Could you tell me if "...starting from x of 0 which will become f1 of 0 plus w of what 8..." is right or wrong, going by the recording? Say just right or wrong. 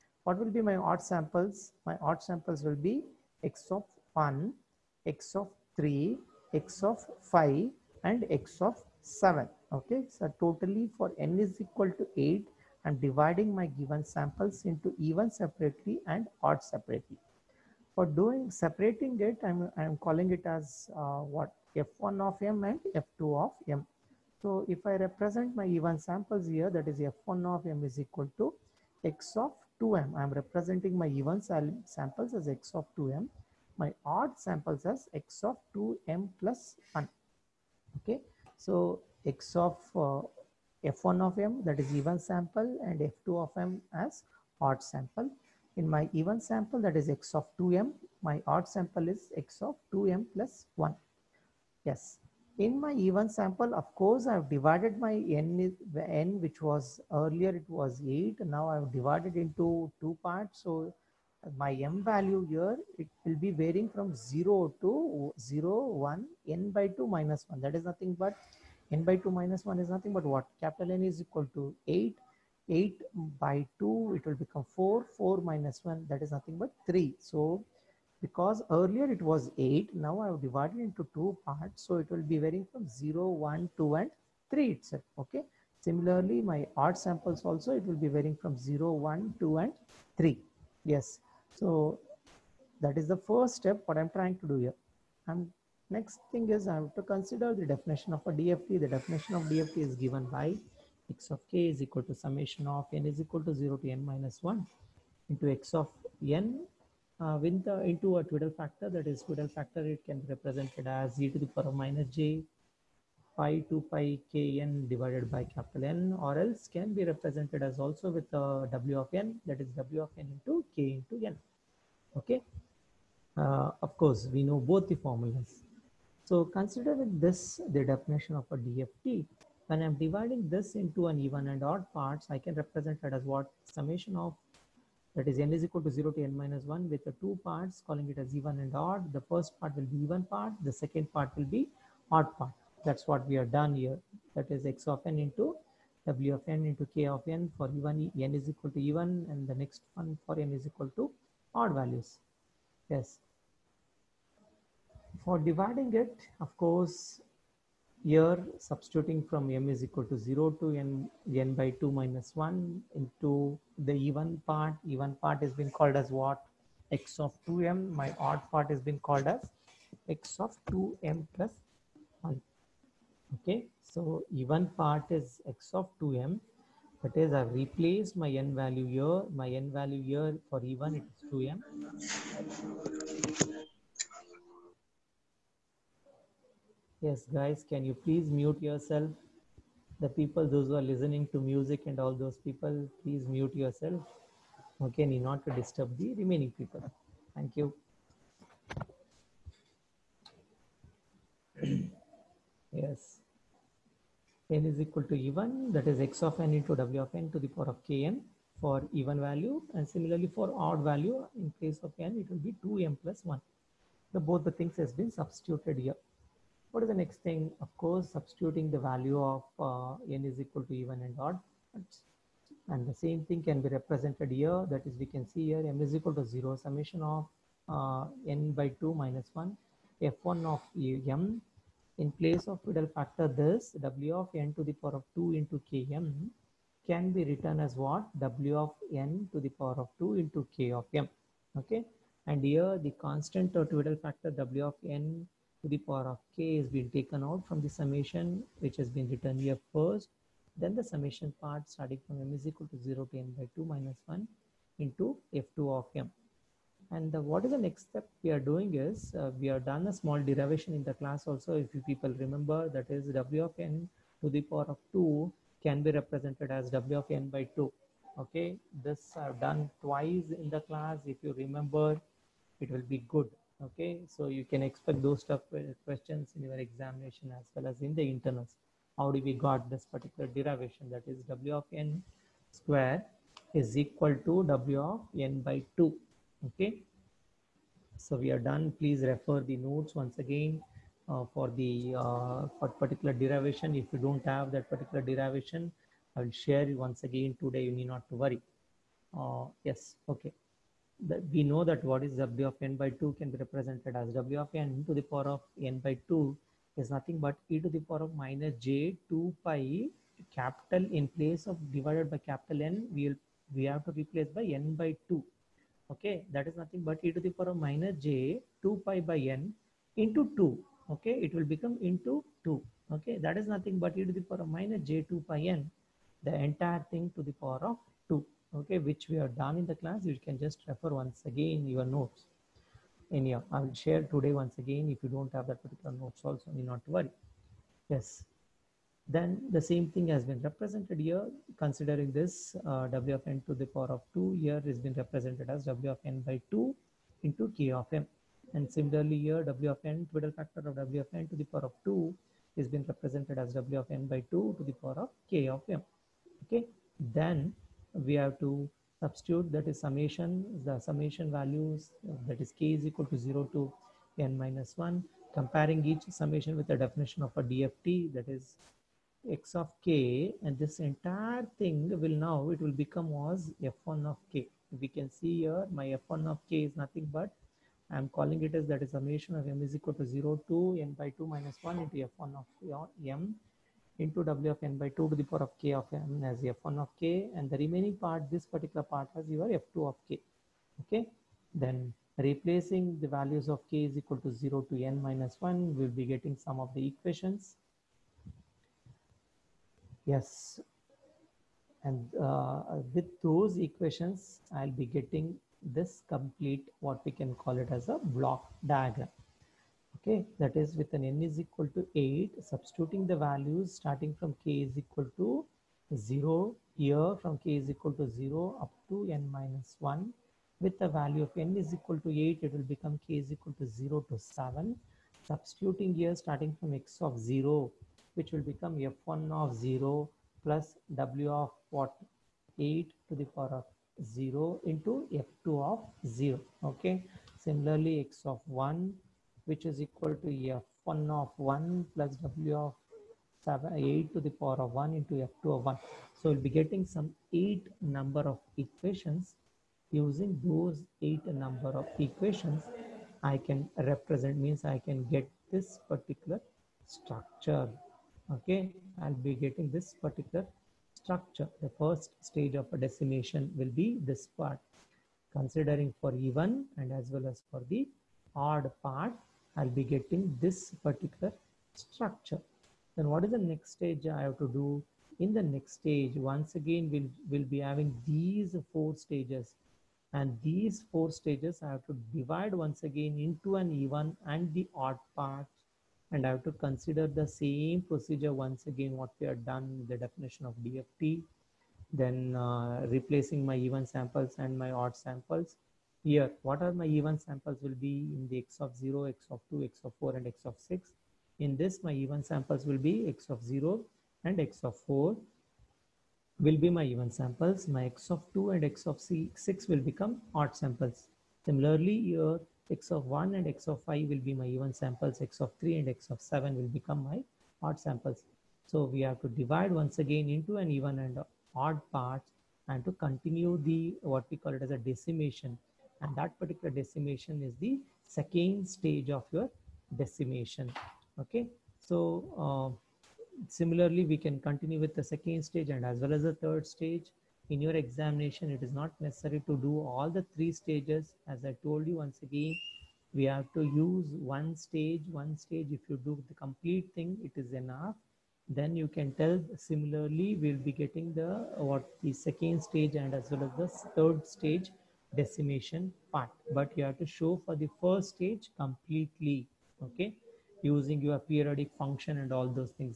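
right.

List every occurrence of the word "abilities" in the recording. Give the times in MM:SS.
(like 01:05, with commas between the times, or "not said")
not said.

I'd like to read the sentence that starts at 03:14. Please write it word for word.
Okay, not to disturb the remaining people.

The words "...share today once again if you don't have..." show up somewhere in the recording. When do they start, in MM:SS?
05:33.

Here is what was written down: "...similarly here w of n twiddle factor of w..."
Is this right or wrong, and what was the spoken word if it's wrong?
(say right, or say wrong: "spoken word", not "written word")
right.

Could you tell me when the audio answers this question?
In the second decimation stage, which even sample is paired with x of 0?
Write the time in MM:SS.
08:23.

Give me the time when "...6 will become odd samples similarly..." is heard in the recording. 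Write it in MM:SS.
08:29.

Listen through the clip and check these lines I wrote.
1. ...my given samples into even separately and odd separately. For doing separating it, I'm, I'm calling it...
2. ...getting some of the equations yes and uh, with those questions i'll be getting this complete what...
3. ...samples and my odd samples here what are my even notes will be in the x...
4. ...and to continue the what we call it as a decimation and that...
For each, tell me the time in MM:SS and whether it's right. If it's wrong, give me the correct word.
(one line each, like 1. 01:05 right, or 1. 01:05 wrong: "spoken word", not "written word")
1. 00:13 right
2. 06:36 wrong: "equations", not "questions"
3. 08:13 wrong: "samples", not "notes"
4. 08:42 right.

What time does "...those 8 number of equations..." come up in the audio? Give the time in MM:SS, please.
07:30.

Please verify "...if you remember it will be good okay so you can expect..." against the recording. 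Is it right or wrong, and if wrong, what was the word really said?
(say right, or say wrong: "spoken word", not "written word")
right.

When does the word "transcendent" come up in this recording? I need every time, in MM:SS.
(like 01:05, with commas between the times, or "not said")
not said.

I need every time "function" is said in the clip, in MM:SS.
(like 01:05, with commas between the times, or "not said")
09:21.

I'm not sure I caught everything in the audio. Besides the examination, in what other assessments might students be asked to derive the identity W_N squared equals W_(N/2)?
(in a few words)
internals.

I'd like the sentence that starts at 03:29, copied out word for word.
And similarly for odd value, in place of n, it will be 2m plus 1.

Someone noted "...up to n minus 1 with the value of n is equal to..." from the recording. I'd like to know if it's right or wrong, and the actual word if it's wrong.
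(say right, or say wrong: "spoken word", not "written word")
right.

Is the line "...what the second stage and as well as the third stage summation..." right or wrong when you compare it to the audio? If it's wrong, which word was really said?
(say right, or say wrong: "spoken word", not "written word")
wrong: "decimation", not "summation".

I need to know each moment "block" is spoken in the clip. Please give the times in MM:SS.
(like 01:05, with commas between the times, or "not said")
06:48.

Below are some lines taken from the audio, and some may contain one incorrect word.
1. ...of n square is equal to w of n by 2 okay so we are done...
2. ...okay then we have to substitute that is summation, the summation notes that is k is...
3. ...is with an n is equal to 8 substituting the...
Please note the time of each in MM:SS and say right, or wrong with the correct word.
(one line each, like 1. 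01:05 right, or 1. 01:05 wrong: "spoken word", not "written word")
1. 04:41 right
2. 05:56 wrong: "values", not "notes"
3. 06:50 right.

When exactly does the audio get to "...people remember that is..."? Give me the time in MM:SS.
04:21.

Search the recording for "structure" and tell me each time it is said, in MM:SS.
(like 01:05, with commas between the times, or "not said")
07:36, 07:40, 07:51.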